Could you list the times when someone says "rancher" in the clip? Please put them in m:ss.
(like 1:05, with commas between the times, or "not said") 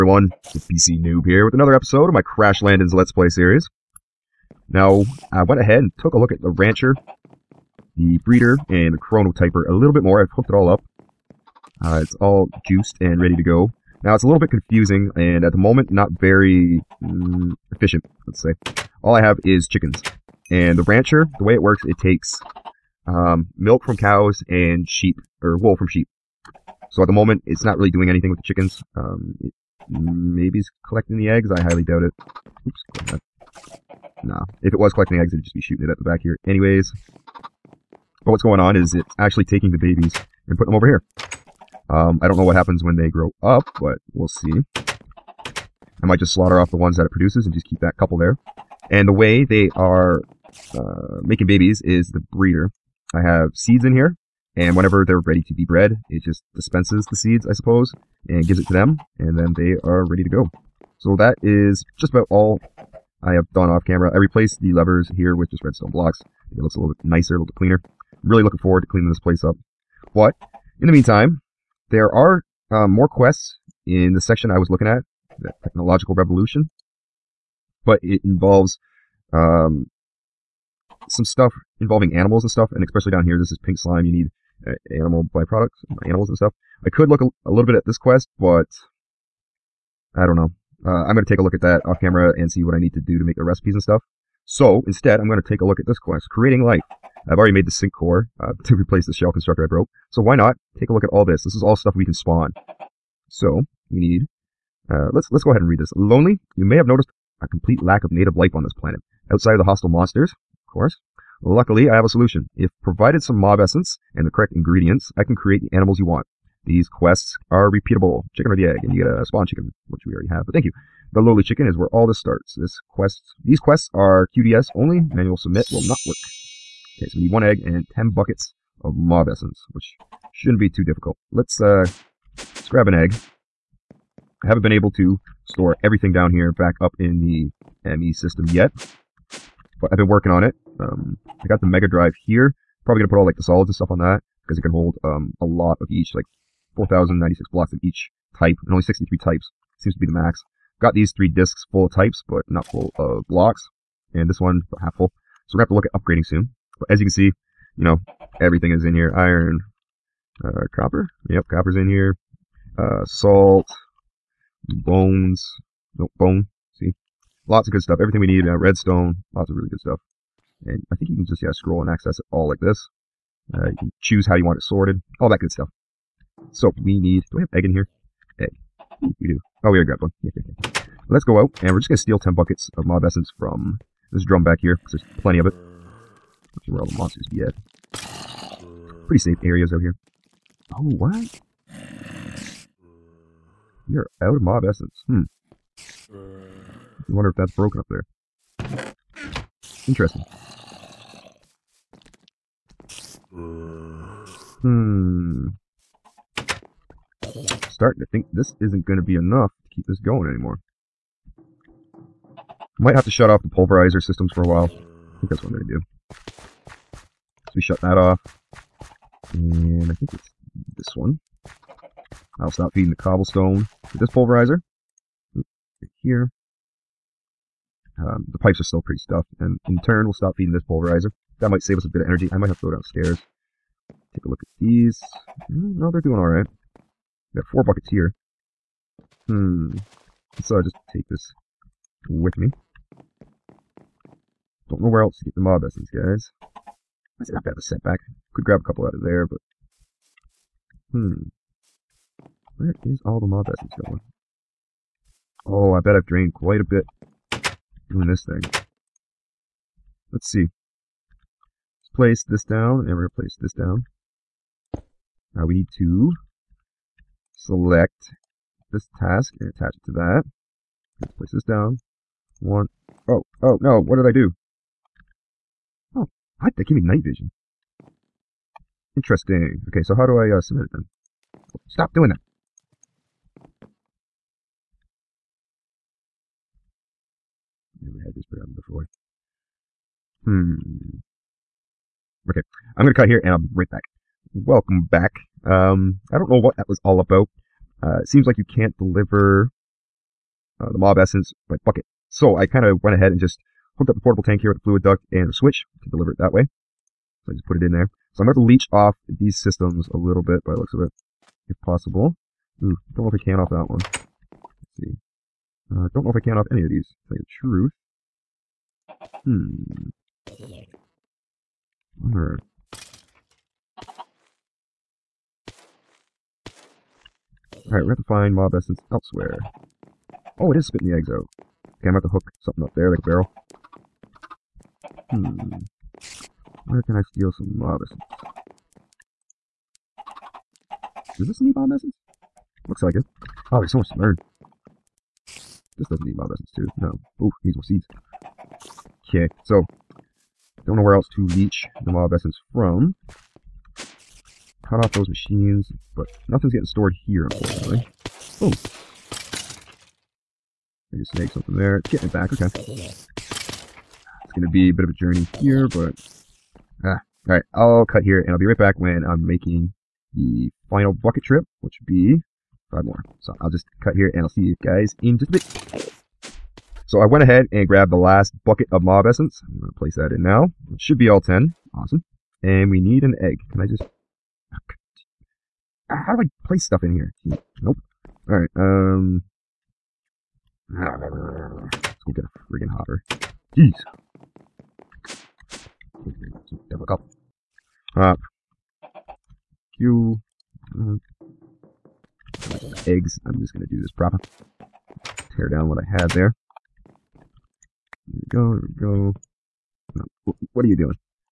0:06, 0:20.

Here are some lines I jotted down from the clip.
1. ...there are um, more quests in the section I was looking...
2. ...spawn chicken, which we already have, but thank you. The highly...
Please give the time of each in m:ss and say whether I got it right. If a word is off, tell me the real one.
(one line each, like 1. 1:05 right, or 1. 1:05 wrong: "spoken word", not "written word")
1. 1:11 right
2. 1:59 wrong: "lowly", not "highly".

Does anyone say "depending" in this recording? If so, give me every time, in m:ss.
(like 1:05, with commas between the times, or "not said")
not said.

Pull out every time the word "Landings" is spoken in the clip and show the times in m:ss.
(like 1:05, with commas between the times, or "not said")
0:02.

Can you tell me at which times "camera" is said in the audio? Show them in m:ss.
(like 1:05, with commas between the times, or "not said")
1:03, 1:32, 5:31.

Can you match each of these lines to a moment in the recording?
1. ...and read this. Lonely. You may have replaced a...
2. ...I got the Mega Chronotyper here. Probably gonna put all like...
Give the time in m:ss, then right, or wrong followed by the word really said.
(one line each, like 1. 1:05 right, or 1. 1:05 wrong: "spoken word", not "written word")
1. 1:45 wrong: "noticed", not "replaced"
2. 2:21 wrong: "Drive", not "Chronotyper".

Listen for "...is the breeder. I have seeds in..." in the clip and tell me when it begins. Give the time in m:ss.
0:51.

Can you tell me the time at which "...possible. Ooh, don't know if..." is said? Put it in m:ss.
5:11.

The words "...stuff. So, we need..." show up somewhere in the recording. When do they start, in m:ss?
2:55.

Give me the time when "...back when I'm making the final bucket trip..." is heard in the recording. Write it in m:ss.
6:08.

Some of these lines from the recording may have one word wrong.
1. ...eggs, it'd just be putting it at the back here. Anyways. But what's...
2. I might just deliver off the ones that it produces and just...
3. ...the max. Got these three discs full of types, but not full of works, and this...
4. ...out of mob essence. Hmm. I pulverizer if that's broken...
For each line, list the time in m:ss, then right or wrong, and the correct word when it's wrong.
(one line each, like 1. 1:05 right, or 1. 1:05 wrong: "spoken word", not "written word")
1. 0:35 wrong: "shooting", not "putting"
2. 0:46 wrong: "slaughter", not "deliver"
3. 2:30 wrong: "blocks", not "works"
4. 3:14 wrong: "wonder", not "pulverizer".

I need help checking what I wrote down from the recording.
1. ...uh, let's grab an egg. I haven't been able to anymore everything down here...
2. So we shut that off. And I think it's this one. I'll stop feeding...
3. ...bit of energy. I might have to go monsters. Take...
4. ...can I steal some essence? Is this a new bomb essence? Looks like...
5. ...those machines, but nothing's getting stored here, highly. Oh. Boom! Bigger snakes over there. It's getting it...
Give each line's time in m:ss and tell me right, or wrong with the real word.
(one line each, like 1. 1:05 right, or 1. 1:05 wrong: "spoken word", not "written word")
1. 2:11 wrong: "store", not "anymore"
2. 3:37 right
3. 3:51 wrong: "downstairs", not "monsters"
4. 5:36 right
5. 5:54 wrong: "unfortunately", not "highly".